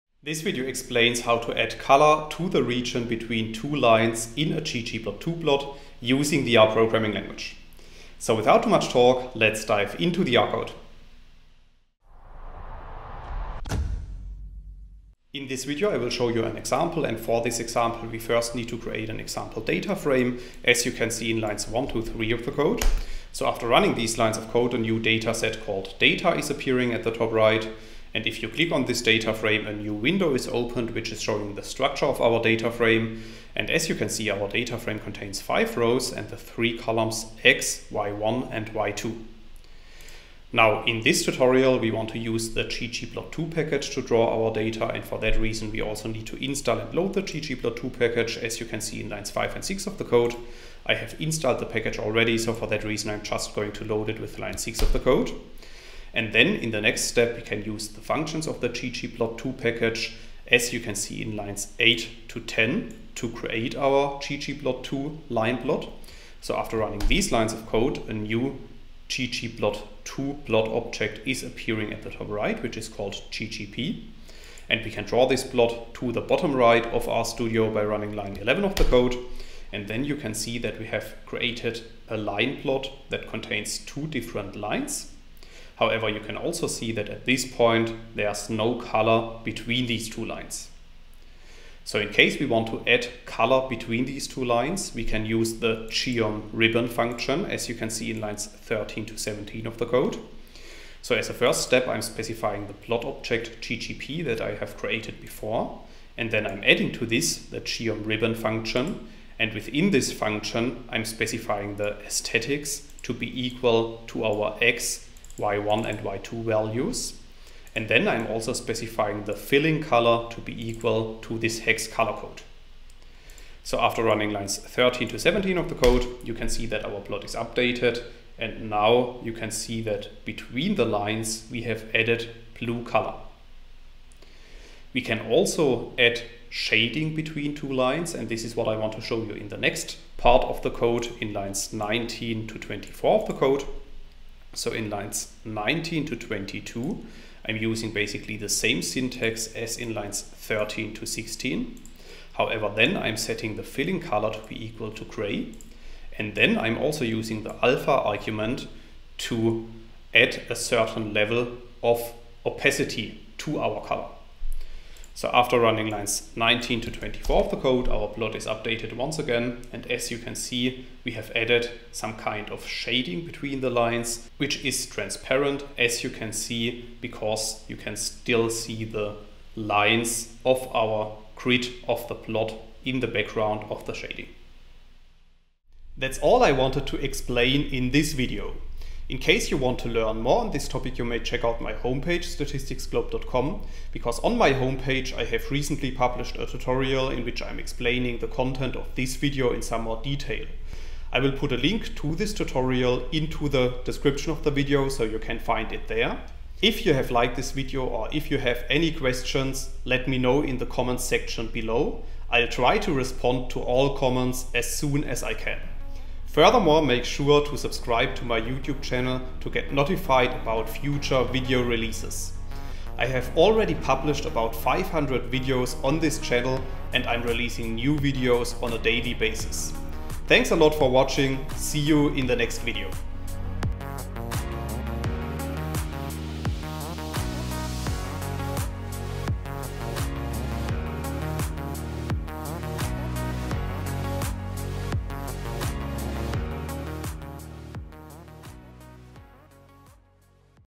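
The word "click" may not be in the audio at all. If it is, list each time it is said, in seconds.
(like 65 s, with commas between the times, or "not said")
28 s.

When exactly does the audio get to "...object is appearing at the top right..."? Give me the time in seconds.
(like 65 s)
70 s.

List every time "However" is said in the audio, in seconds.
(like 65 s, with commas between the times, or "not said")
85 s, 152 s.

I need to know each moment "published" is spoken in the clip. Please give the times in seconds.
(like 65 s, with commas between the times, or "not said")
195 s, 223 s.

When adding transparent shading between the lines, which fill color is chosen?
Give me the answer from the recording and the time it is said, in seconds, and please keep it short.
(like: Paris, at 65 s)
gray, at 155 s.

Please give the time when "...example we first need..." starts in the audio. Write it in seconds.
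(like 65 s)
17 s.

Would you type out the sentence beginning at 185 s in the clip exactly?
That's all I wanted to explain in this video.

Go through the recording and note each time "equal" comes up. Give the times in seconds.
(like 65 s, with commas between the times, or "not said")
113 s, 120 s, 154 s.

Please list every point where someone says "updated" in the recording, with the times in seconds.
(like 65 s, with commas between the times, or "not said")
127 s, 168 s.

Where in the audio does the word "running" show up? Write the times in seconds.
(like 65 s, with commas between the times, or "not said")
23 s, 66 s, 77 s, 124 s, 165 s.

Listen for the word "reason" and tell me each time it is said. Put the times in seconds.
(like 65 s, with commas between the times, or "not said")
45 s, 52 s.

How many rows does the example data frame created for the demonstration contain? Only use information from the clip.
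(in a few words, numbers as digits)
5.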